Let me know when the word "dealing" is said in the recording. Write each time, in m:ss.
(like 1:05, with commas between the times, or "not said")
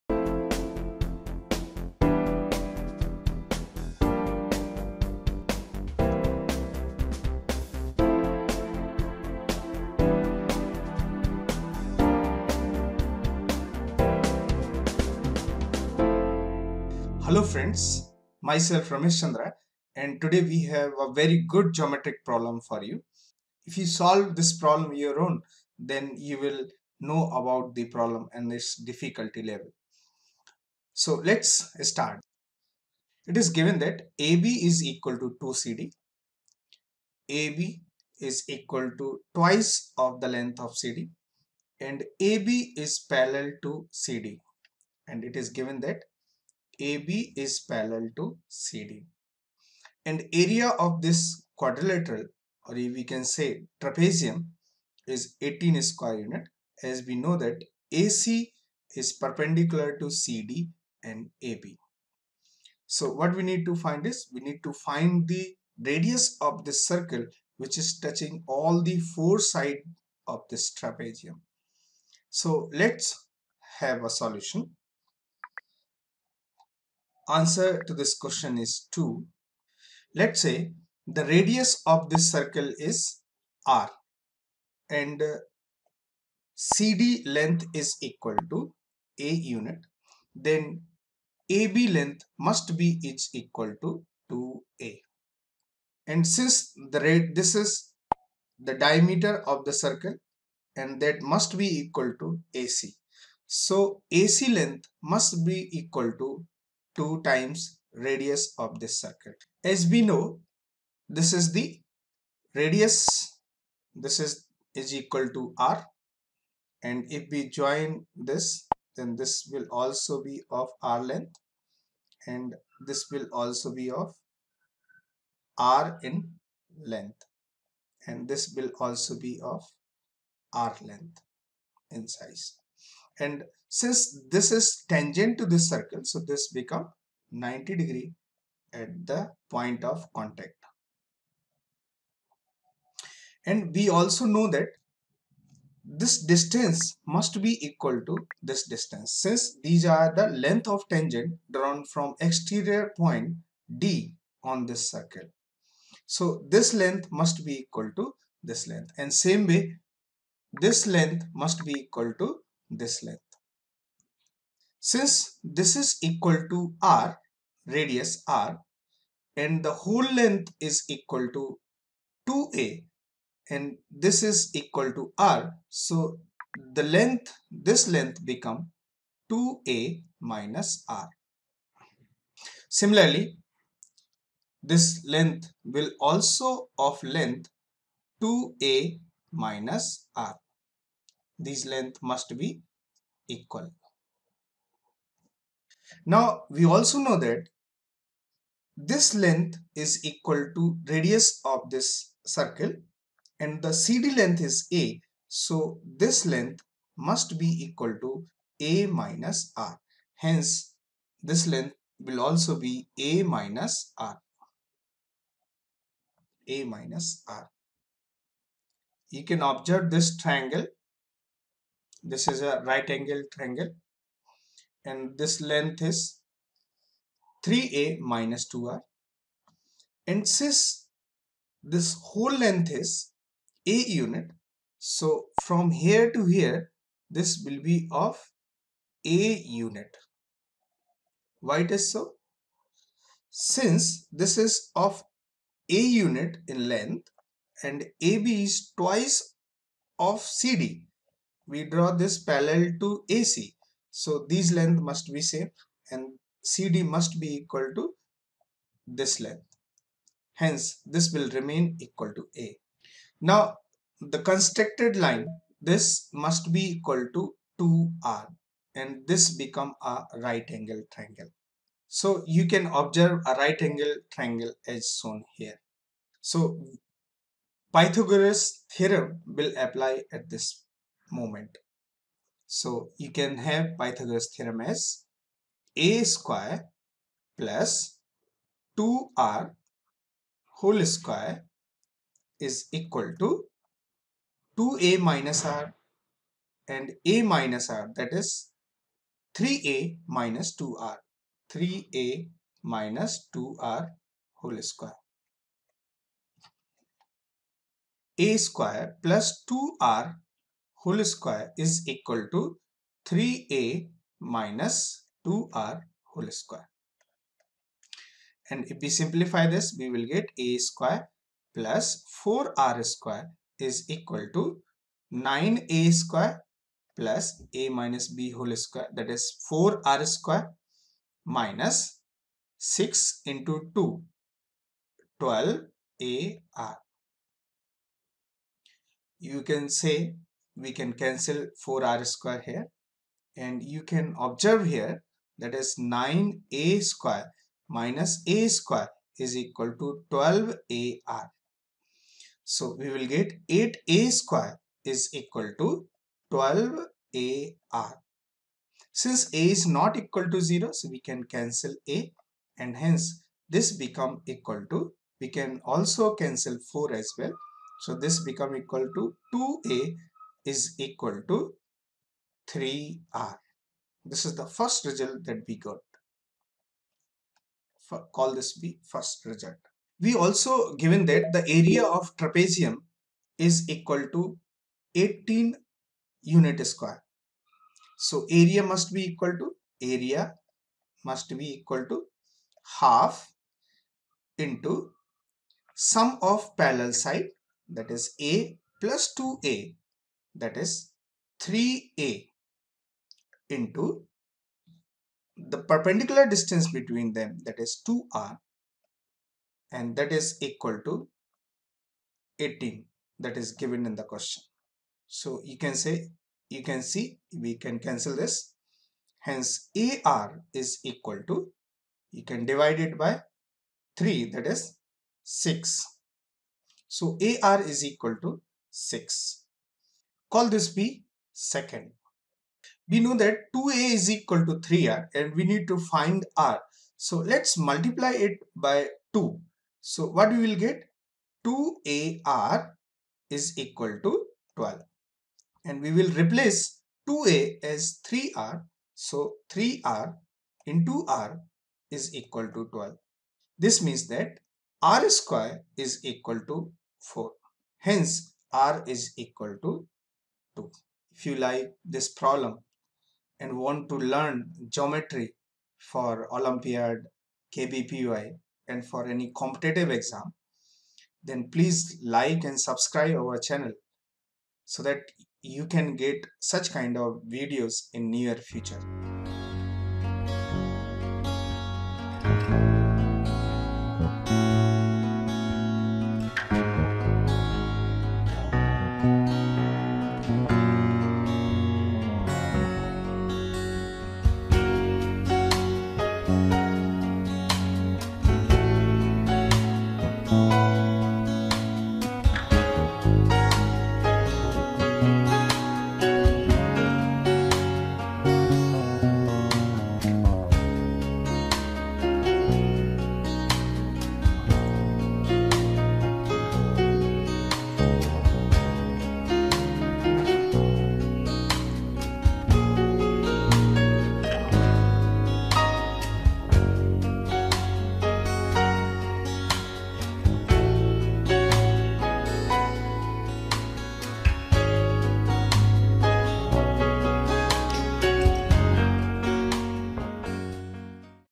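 not said.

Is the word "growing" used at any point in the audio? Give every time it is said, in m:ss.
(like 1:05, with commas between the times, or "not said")
not said.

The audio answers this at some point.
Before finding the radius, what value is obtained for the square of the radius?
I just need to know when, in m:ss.
7:34.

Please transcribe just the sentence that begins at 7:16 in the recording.
So let's multiply it by 2.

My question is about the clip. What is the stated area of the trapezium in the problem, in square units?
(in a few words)
18.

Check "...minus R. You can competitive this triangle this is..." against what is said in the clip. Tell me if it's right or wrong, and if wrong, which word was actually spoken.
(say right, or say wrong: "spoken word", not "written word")
wrong: "observe", not "competitive".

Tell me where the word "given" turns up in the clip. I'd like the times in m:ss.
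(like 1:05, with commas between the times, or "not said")
0:33, 0:45, 6:20, 6:53.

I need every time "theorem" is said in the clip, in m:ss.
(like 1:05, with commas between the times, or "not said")
4:38, 4:44.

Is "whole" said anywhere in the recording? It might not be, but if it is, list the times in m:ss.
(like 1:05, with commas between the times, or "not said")
2:49, 3:52, 4:50, 5:04, 5:10, 5:16, 5:28.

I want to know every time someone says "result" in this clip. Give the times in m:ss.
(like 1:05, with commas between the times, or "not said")
6:14, 6:19.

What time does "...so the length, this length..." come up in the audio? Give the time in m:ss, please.
2:55.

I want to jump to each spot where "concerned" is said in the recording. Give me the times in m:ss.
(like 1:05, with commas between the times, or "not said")
not said.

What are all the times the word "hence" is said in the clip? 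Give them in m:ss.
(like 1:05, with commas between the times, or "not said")
3:30, 4:20, 6:02, 6:59, 7:37.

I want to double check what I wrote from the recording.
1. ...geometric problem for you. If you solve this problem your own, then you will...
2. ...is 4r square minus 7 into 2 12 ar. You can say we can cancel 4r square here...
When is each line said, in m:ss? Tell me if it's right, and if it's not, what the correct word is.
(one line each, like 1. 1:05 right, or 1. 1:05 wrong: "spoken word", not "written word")
1. 0:21 right
2. 5:29 wrong: "6", not "7".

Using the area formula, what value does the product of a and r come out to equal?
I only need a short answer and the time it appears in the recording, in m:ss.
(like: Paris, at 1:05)
6, at 7:07.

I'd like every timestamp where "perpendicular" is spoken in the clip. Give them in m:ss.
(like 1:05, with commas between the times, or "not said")
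0:59, 6:45.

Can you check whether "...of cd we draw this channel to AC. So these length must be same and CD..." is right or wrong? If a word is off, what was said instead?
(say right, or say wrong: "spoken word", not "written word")
wrong: "parallel", not "channel".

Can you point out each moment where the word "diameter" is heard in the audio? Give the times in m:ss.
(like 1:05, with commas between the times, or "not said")
1:38.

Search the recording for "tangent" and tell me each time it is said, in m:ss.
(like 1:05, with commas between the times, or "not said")
2:14, 2:30.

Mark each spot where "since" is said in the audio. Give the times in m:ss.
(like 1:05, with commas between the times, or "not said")
1:36, 2:13, 2:29, 2:44, 3:50, 4:03, 5:58.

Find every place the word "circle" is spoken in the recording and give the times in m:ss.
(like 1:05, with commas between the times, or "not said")
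1:06, 1:22, 1:39, 1:48, 2:15, 2:34, 3:22.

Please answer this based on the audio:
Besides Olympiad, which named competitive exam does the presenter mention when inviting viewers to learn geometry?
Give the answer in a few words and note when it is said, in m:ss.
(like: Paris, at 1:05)
KVPY, at 7:47.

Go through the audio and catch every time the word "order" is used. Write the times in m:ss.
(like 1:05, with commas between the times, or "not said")
not said.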